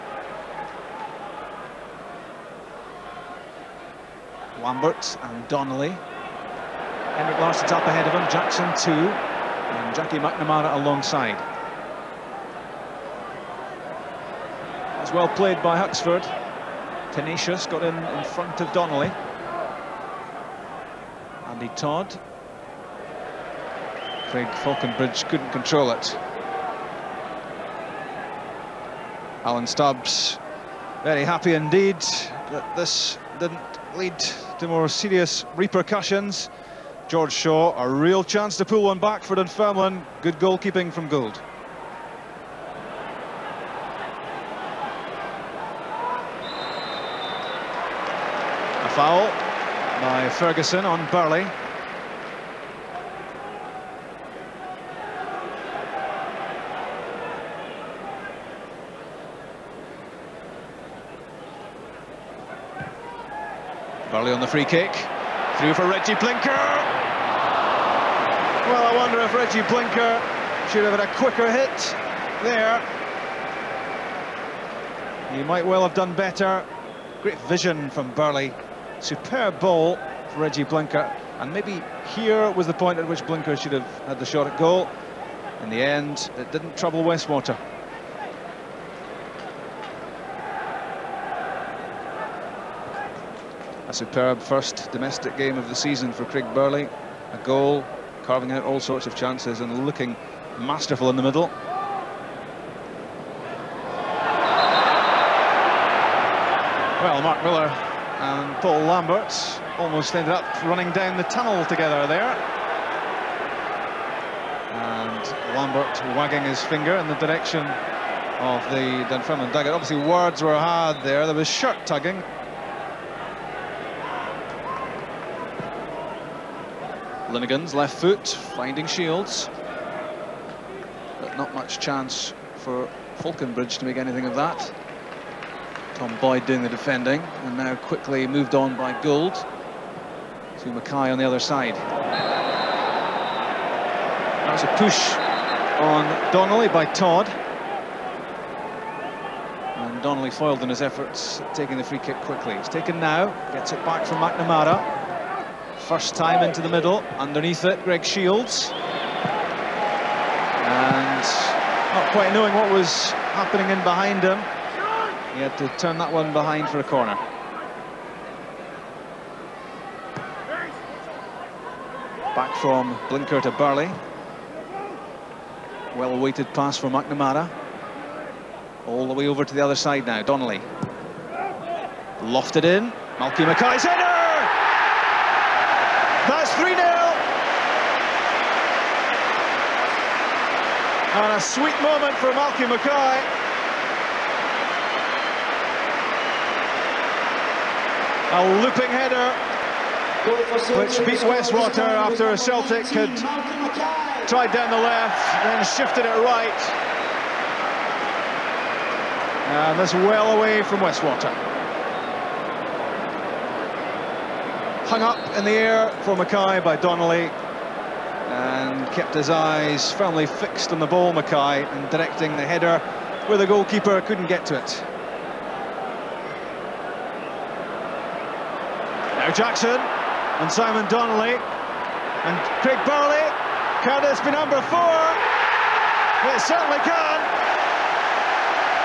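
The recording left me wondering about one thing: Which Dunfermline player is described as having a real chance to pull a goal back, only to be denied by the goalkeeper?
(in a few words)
George Shaw.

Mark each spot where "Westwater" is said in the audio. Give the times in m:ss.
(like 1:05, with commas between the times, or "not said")
1:27, 3:21, 3:30.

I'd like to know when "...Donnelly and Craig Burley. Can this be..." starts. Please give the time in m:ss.
3:50.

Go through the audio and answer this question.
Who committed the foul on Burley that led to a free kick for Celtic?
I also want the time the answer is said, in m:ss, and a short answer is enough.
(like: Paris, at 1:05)
Ferguson, at 0:50.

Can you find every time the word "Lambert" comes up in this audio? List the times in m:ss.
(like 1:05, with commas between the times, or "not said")
0:04, 1:48, 1:55.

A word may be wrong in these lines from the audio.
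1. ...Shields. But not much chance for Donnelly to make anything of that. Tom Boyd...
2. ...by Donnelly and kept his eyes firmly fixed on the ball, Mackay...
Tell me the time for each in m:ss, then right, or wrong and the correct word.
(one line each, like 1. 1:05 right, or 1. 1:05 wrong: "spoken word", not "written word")
1. 2:08 wrong: "Faulconbridge", not "Donnelly"
2. 3:36 right.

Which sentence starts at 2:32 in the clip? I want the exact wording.
He's taken now, gets it back from McNamara.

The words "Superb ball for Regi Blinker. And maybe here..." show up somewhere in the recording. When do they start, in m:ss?
1:18.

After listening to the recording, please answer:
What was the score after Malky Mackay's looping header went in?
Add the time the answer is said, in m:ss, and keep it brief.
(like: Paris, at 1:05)
3-0, at 3:06.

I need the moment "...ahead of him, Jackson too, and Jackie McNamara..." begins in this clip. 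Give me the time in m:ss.
0:07.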